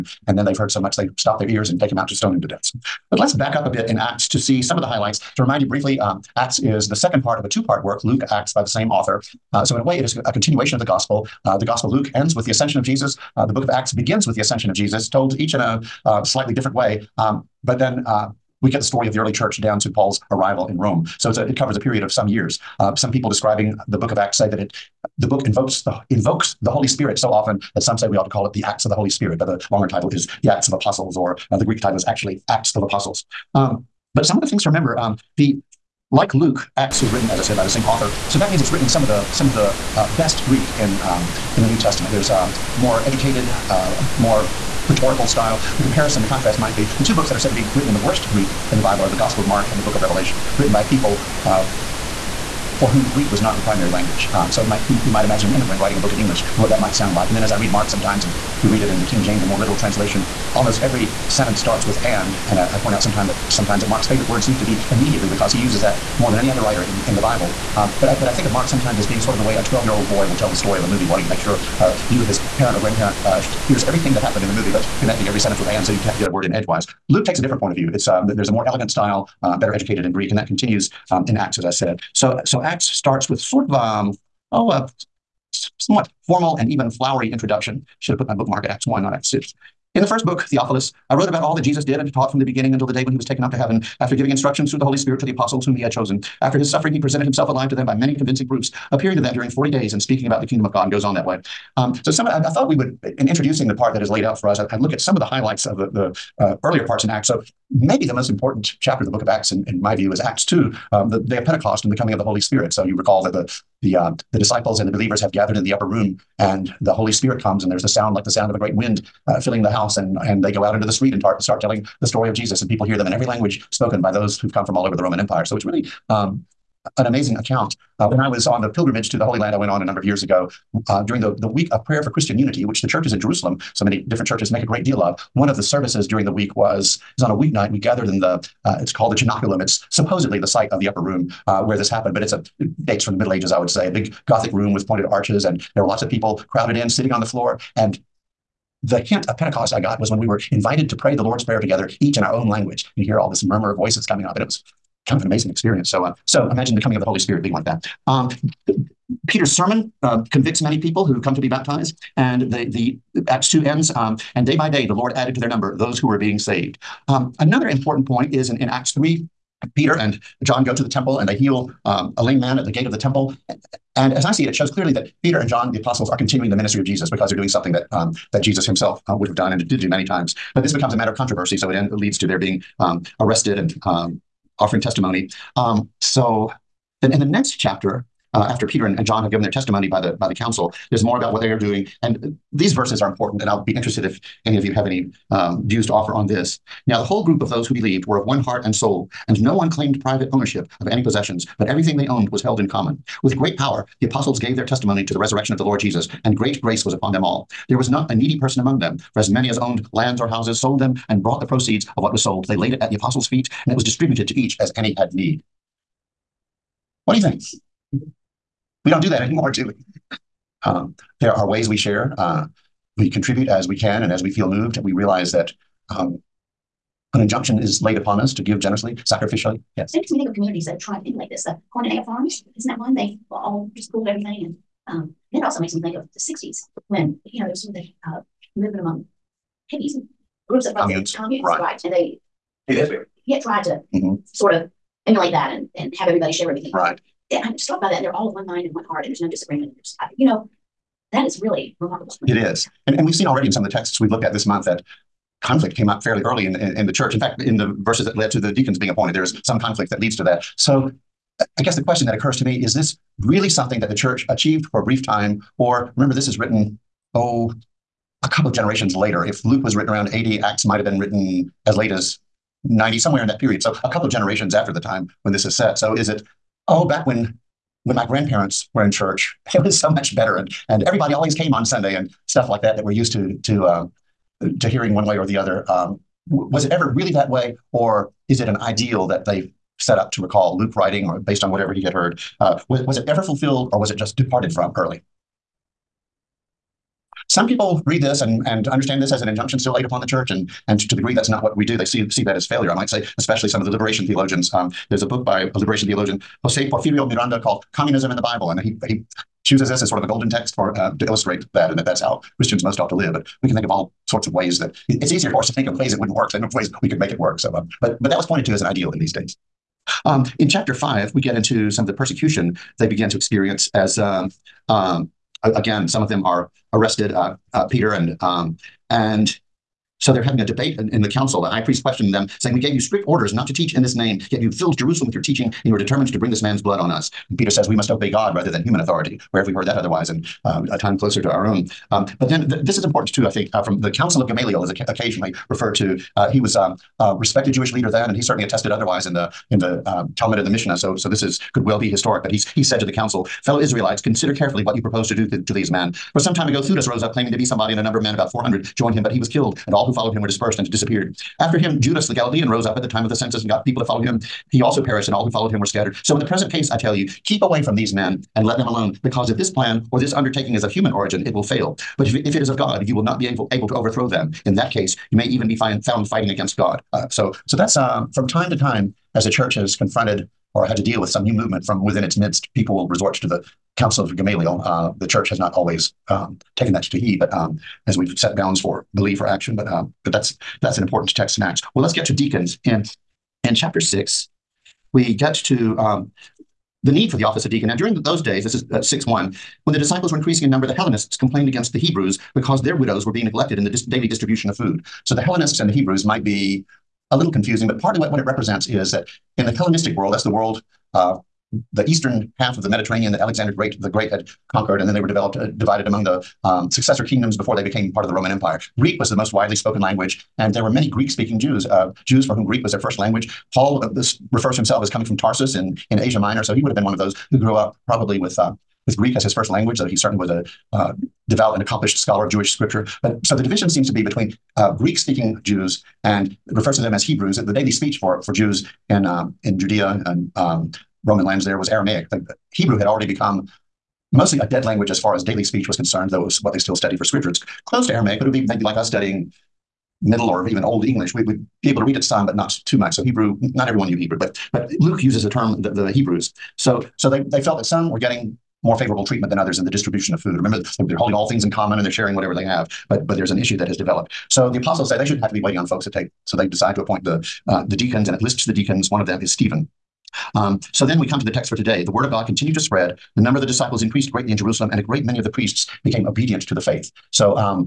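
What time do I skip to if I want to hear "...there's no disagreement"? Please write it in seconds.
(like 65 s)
249 s.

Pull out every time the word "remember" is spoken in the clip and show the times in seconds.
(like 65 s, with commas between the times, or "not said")
34 s, 265 s, 460 s.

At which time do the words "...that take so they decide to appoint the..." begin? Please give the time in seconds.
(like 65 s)
465 s.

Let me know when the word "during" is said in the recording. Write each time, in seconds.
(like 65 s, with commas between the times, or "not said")
99 s, 131 s, 136 s, 397 s.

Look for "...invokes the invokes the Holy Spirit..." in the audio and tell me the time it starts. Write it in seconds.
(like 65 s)
25 s.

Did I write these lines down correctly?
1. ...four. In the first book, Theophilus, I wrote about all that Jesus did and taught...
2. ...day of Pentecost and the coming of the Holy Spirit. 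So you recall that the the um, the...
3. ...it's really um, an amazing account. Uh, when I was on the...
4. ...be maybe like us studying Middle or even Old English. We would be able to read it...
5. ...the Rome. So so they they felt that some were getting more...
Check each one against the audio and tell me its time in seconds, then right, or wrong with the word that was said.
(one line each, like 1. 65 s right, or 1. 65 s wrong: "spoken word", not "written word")
1. 89 s wrong: "six", not "four"
2. 111 s right
3. 125 s right
4. 448 s right
5. 455 s wrong: "Hebrews", not "Rome".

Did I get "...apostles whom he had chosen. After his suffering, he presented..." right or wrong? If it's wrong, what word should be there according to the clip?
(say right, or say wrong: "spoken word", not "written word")
right.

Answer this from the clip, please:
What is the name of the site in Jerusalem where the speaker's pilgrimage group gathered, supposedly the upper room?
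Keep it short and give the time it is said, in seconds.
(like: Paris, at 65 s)
Cenaculum, at 139 s.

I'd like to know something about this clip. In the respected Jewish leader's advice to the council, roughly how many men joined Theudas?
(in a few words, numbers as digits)
400.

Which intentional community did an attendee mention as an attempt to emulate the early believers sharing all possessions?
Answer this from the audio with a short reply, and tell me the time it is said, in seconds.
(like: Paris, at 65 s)
Koinonia Farms, at 231 s.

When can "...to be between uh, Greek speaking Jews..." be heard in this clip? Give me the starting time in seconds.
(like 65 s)
433 s.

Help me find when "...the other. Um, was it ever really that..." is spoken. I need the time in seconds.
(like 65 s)
285 s.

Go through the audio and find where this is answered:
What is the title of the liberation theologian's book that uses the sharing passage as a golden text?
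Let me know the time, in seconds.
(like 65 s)
307 s.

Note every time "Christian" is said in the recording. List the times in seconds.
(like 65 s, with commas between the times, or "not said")
132 s, 312 s.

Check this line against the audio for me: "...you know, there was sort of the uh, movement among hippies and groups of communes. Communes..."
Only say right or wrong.
right.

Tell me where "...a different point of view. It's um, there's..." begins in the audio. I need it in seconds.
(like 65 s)
77 s.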